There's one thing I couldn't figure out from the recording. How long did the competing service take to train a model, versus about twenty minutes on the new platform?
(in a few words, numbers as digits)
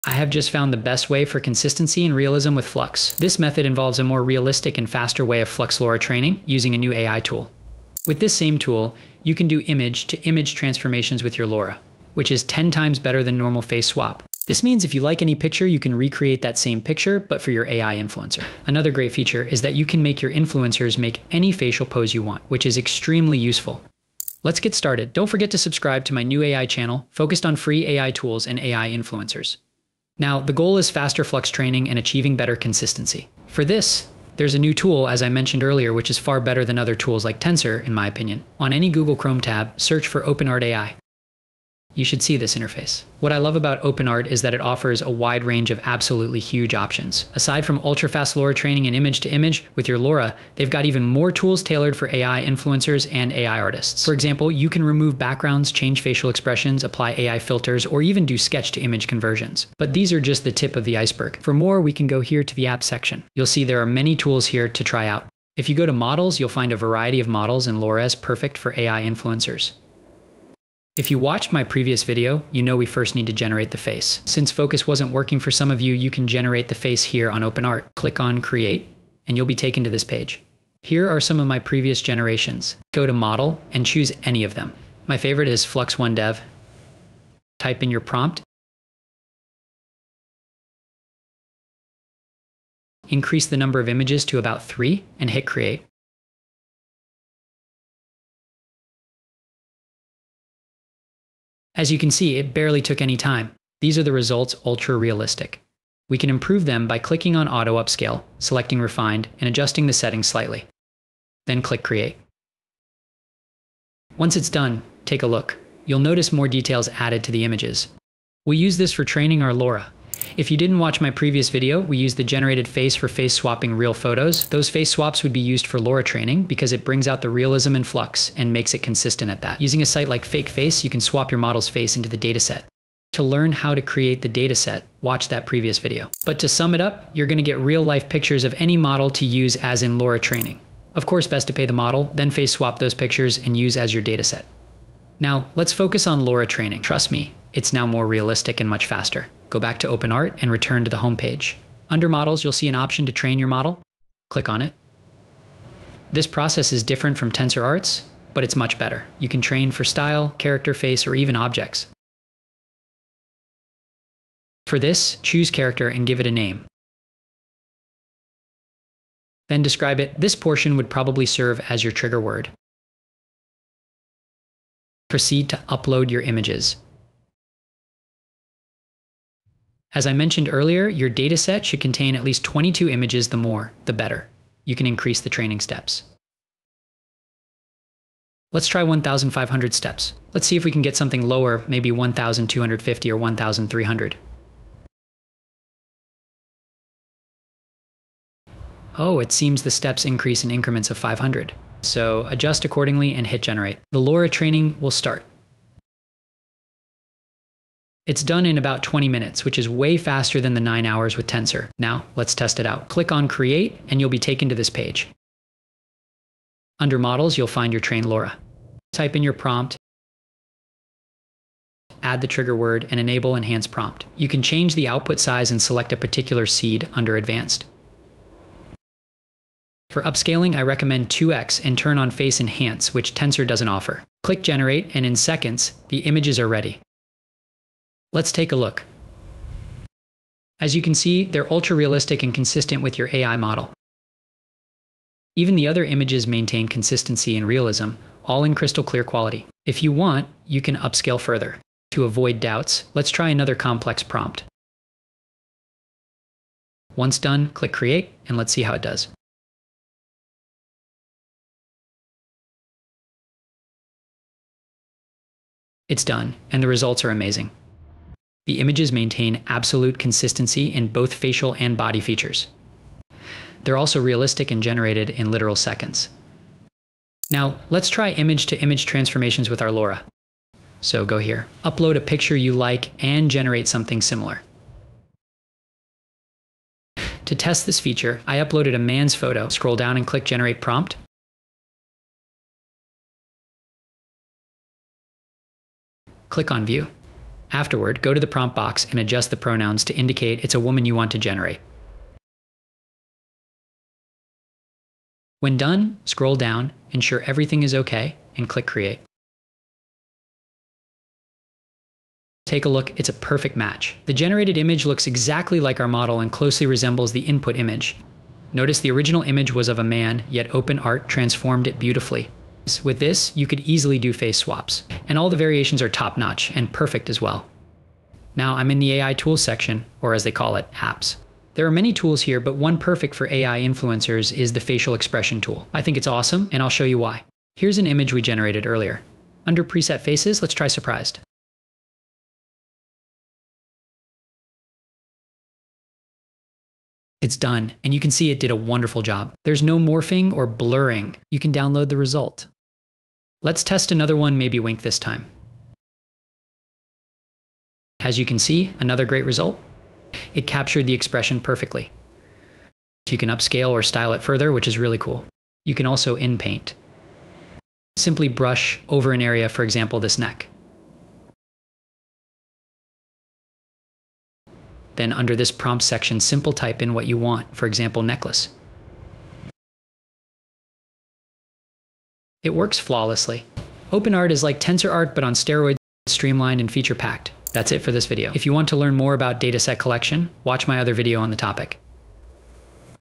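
9 hours.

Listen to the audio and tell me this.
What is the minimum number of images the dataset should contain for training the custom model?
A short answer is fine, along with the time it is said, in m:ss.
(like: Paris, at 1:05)
22, at 3:02.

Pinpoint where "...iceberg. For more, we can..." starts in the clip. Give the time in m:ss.
1:00.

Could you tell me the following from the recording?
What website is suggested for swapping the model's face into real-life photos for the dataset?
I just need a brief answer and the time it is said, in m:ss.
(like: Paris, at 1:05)
Fake Face, at 2:10.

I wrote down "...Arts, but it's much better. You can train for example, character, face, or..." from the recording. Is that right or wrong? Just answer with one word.
wrong.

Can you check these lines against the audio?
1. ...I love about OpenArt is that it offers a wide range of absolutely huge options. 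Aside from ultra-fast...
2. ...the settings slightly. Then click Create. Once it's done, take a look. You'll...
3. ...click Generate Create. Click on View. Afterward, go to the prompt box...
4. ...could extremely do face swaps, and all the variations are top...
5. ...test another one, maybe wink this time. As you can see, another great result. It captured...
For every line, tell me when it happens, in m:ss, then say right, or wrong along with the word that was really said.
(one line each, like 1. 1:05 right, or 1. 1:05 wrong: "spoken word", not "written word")
1. 0:43 right
2. 1:49 right
3. 4:50 wrong: "Prompt", not "Create"
4. 5:23 wrong: "easily", not "extremely"
5. 5:53 right.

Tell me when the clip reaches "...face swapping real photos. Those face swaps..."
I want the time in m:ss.
2:03.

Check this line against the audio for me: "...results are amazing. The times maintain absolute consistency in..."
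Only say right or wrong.
wrong.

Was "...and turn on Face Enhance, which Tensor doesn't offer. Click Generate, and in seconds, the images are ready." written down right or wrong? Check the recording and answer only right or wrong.
right.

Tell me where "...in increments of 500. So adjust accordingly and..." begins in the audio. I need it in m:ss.
3:20.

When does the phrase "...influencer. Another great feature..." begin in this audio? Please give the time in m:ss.
0:17.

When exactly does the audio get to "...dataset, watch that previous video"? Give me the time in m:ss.
2:14.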